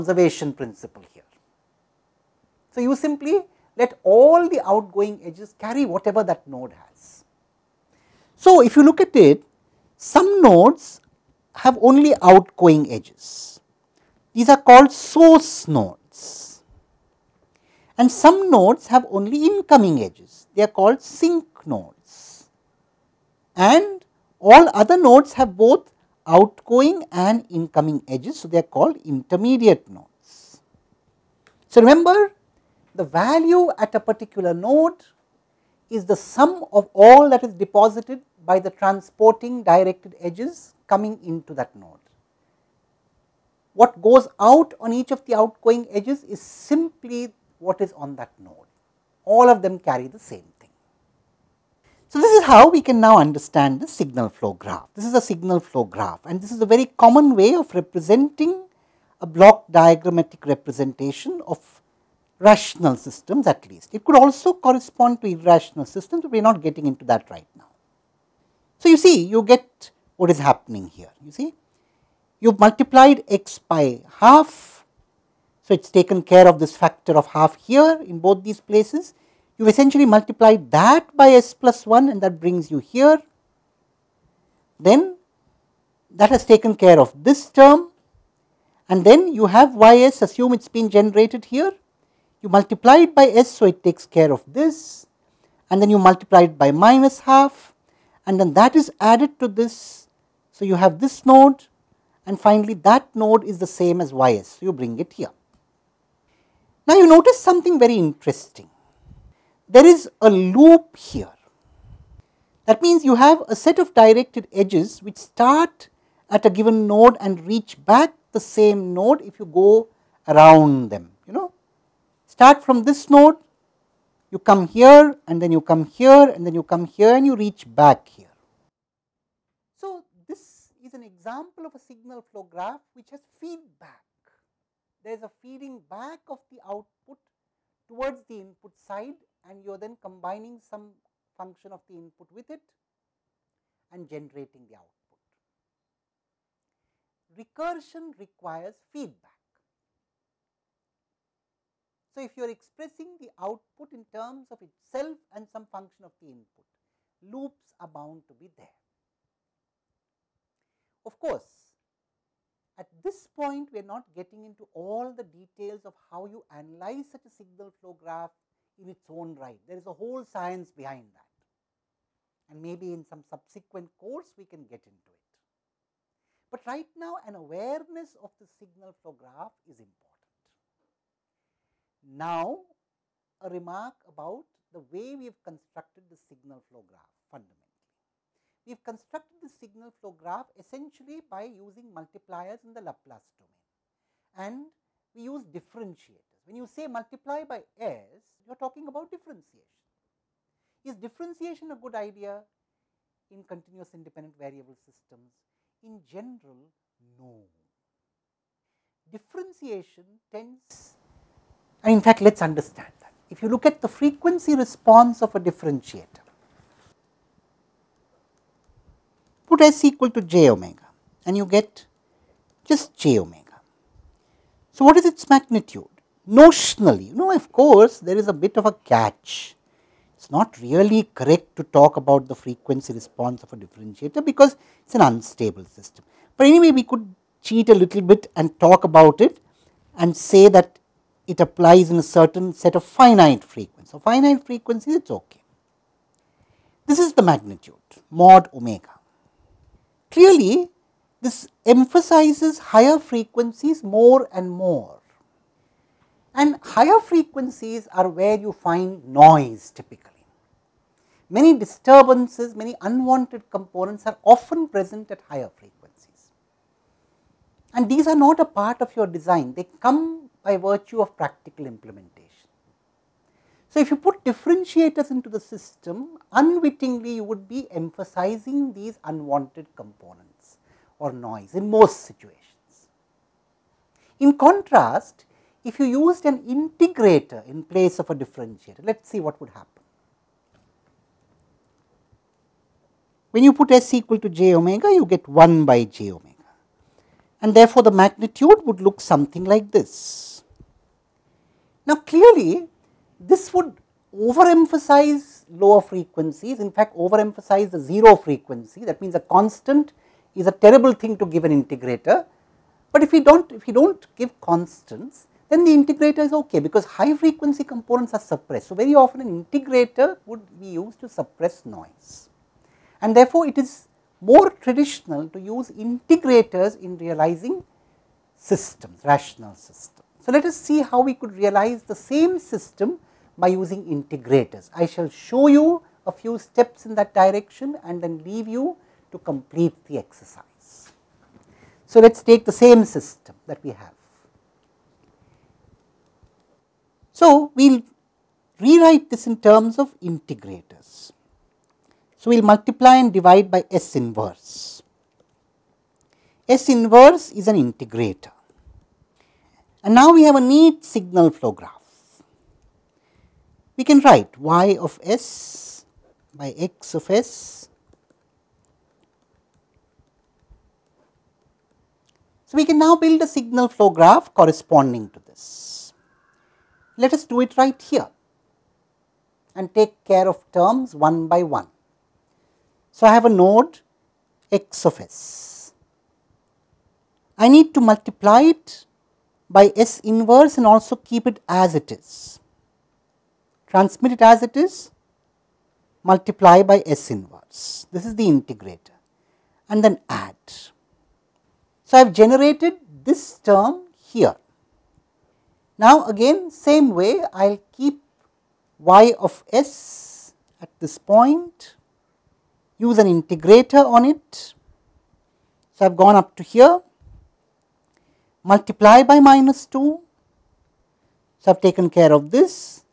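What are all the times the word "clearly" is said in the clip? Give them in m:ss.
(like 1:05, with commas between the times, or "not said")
4:10, 5:02.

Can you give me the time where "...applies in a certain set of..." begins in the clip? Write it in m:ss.
4:01.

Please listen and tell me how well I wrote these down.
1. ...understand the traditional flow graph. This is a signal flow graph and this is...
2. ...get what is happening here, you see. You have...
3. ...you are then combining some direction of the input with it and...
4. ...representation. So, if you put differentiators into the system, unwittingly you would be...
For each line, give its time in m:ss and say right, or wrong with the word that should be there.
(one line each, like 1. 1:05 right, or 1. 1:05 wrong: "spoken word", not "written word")
1. 0:53 wrong: "signal", not "traditional"
2. 1:09 right
3. 2:19 wrong: "function", not "direction"
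4. 4:31 wrong: "implementation", not "representation".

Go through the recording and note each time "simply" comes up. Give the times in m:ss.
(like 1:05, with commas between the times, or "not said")
0:02, 0:46.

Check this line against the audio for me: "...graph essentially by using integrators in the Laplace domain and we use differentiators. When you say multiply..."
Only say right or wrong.
wrong.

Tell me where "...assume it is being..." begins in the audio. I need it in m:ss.
1:30.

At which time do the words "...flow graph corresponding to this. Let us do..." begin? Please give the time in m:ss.
6:13.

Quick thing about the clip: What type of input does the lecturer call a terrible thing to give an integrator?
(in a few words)
a constant.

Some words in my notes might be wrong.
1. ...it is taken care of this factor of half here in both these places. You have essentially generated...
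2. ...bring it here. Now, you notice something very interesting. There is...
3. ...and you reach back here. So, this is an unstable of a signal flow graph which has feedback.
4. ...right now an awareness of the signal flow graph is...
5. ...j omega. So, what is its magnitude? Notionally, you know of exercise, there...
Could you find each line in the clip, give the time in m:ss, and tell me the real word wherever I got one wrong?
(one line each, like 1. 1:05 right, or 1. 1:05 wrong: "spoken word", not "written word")
1. 1:15 wrong: "multiplied", not "generated"
2. 1:44 right
3. 2:07 wrong: "example", not "unstable"
4. 2:56 right
5. 3:42 wrong: "course", not "exercise".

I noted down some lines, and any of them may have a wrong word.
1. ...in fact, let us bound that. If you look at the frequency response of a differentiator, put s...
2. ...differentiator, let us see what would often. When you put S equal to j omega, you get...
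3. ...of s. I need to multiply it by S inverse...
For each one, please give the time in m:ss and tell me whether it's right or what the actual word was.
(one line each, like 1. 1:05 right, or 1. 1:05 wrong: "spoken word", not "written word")
1. 3:31 wrong: "understand", not "bound"
2. 4:48 wrong: "happen", not "often"
3. 6:24 right.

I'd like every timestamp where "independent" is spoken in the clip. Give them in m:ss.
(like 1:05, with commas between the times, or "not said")
3:23.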